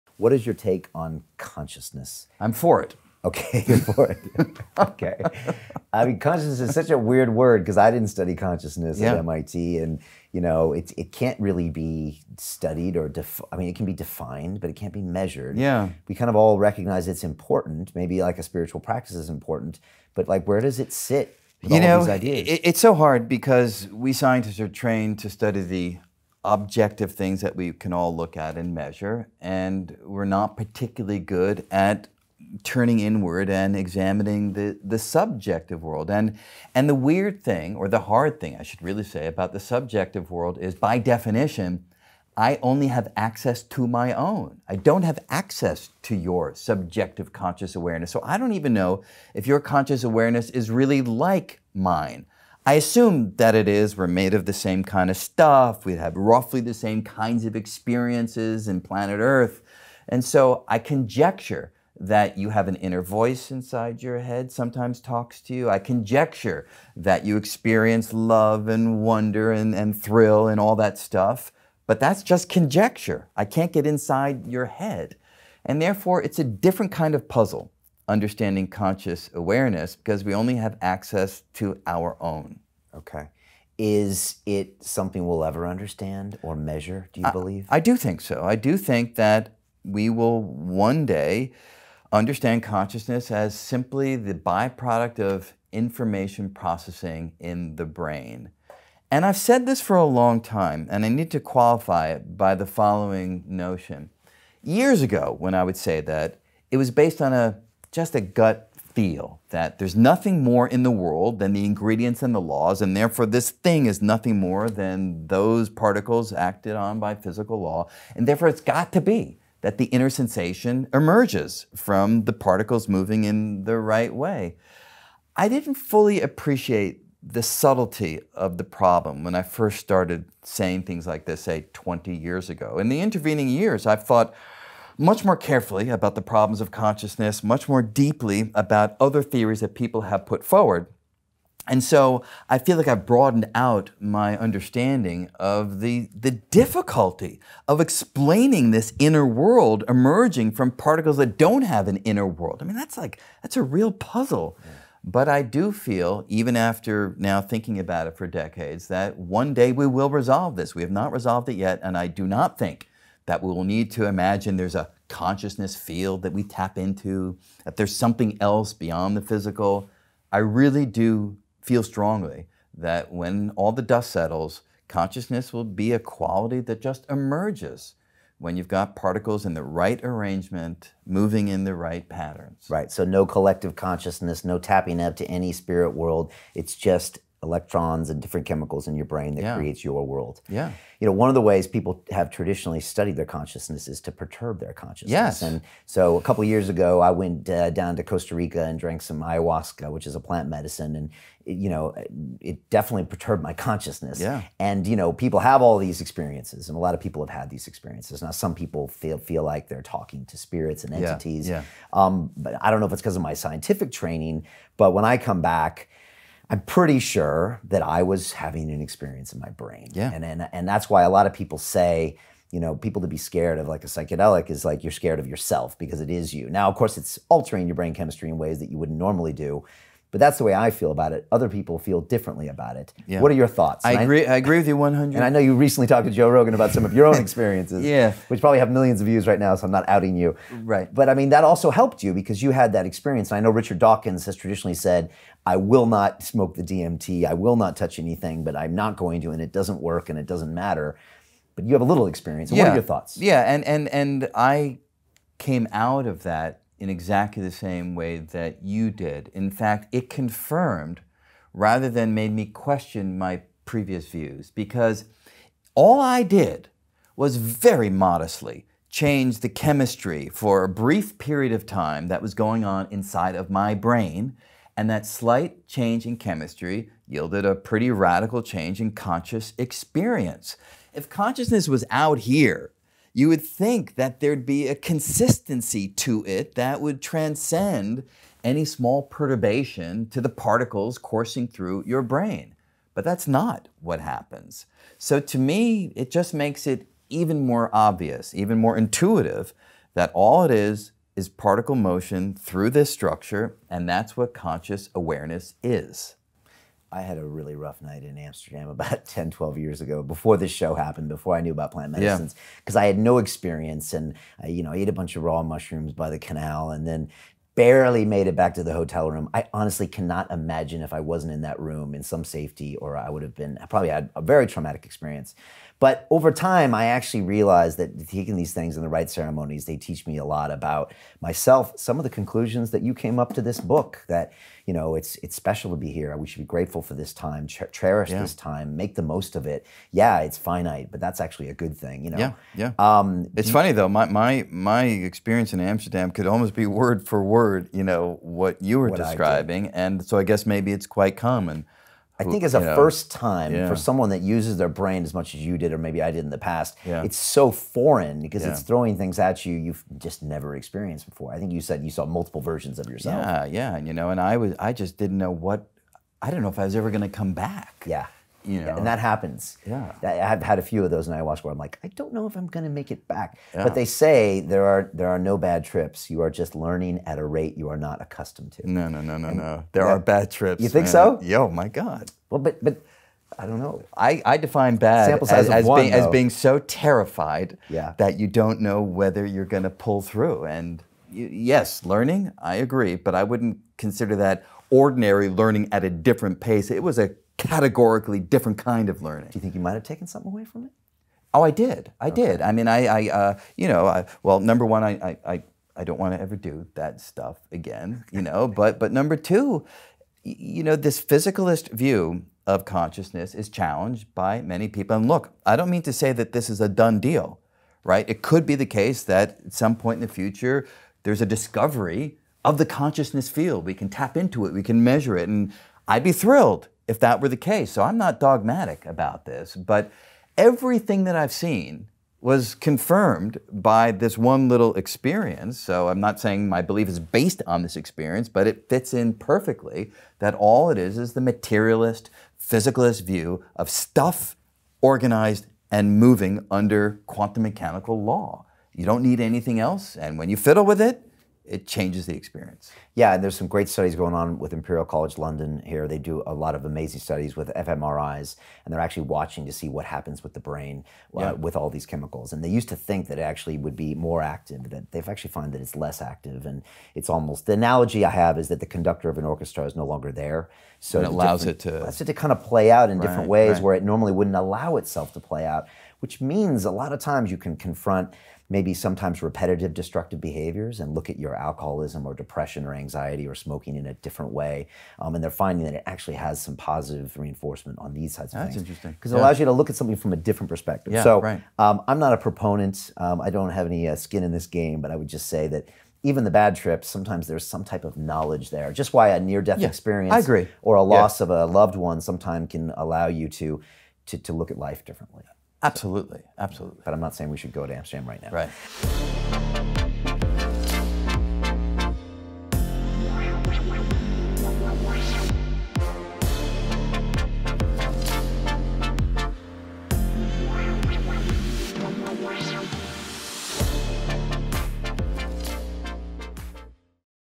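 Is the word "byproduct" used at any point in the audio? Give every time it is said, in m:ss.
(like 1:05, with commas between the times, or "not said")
1:34.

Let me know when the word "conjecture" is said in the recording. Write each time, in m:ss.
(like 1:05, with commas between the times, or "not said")
1:00, 1:05, 1:12.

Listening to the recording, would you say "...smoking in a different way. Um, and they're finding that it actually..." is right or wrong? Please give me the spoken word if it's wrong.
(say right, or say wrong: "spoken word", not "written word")
right.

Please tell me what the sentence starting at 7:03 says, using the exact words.
We can tap into it, we can measure it, and I'd be thrilled if that were the case.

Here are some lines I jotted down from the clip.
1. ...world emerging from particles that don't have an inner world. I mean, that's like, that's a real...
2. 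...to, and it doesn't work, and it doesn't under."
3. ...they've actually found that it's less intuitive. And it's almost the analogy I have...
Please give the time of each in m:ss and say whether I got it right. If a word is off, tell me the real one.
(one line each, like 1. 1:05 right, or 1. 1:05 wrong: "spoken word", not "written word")
1. 2:29 right
2. 4:09 wrong: "matter", not "under"
3. 7:44 wrong: "active", not "intuitive".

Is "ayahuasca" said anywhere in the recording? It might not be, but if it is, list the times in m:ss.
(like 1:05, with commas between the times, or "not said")
3:19, 6:11.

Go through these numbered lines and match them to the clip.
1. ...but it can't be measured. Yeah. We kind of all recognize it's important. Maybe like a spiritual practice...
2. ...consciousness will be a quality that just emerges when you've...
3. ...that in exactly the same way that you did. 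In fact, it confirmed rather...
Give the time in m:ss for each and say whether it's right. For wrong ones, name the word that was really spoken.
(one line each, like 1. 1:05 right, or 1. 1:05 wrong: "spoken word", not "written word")
1. 0:14 right
2. 2:54 right
3. 4:16 right.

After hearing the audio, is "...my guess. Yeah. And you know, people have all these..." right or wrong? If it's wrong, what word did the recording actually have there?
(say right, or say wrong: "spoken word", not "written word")
wrong: "consciousness", not "guess".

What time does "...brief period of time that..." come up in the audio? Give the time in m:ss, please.
4:30.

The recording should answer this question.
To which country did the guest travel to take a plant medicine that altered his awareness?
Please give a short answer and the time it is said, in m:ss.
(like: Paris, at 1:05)
Costa Rica, at 3:18.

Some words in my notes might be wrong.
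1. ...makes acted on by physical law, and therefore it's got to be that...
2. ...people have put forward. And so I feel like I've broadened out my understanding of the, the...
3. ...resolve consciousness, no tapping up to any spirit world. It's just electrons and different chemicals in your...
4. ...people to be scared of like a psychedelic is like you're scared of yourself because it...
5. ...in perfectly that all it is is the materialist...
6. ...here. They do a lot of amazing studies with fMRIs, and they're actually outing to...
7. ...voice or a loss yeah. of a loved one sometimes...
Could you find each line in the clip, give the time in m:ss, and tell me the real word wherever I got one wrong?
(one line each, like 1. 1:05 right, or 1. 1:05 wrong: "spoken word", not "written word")
1. 1:55 wrong: "particles", not "makes"
2. 2:19 right
3. 3:03 wrong: "collective", not "resolve"
4. 3:42 right
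5. 7:18 right
6. 7:35 wrong: "watching", not "outing"
7. 8:19 wrong: "experience", not "voice".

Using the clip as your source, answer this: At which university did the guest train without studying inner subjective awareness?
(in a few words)
MIT.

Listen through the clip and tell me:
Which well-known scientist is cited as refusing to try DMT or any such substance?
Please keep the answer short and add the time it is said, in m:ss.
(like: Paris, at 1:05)
Richard Dawkins, at 4:03.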